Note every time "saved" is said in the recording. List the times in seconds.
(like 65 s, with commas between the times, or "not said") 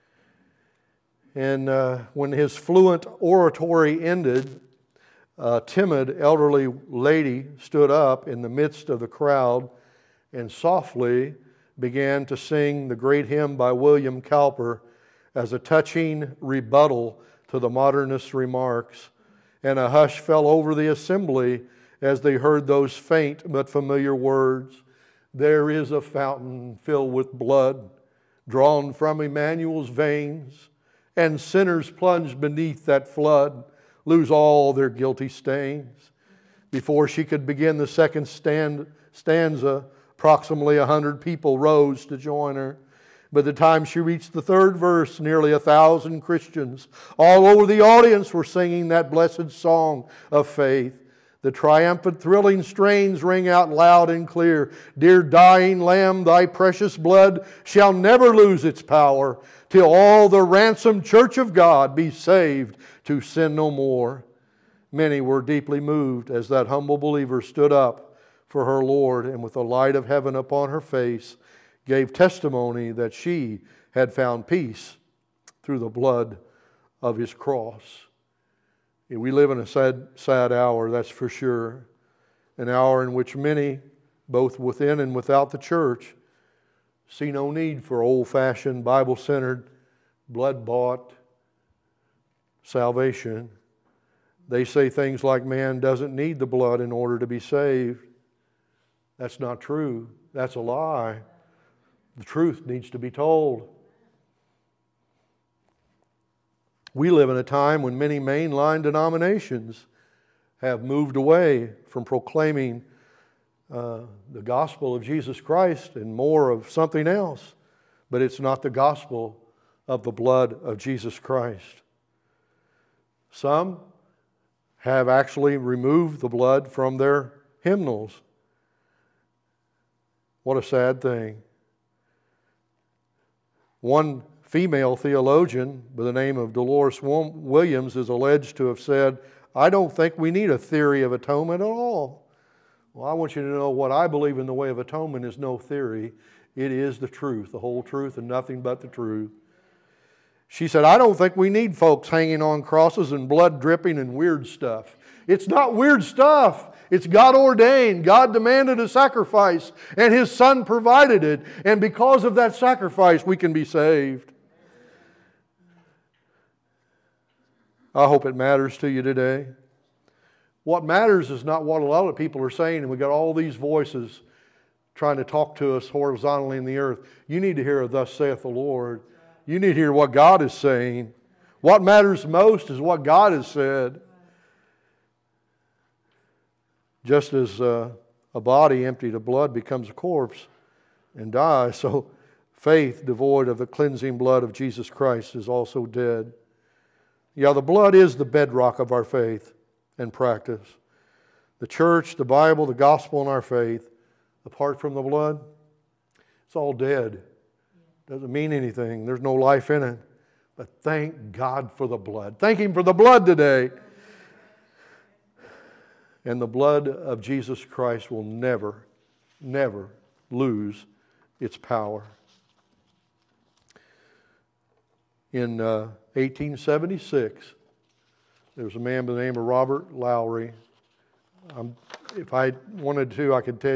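62 s, 97 s, 163 s.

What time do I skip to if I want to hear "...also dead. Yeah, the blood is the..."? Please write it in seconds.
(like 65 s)
195 s.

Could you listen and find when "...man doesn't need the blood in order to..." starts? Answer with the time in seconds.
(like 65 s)
95 s.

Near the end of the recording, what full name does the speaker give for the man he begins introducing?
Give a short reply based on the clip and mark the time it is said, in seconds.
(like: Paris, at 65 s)
Robert Lowry, at 229 s.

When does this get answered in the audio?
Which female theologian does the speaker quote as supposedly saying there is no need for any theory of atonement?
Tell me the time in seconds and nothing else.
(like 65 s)
136 s.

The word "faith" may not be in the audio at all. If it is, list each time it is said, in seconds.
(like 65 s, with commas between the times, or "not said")
50 s, 192 s, 199 s, 203 s.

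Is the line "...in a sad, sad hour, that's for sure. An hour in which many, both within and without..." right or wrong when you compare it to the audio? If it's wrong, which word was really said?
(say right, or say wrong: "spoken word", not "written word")
right.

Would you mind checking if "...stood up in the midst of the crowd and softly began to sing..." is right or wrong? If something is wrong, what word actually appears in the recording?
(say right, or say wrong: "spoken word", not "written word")
right.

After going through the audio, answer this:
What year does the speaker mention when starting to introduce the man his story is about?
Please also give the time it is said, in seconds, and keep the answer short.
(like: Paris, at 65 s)
1876, at 226 s.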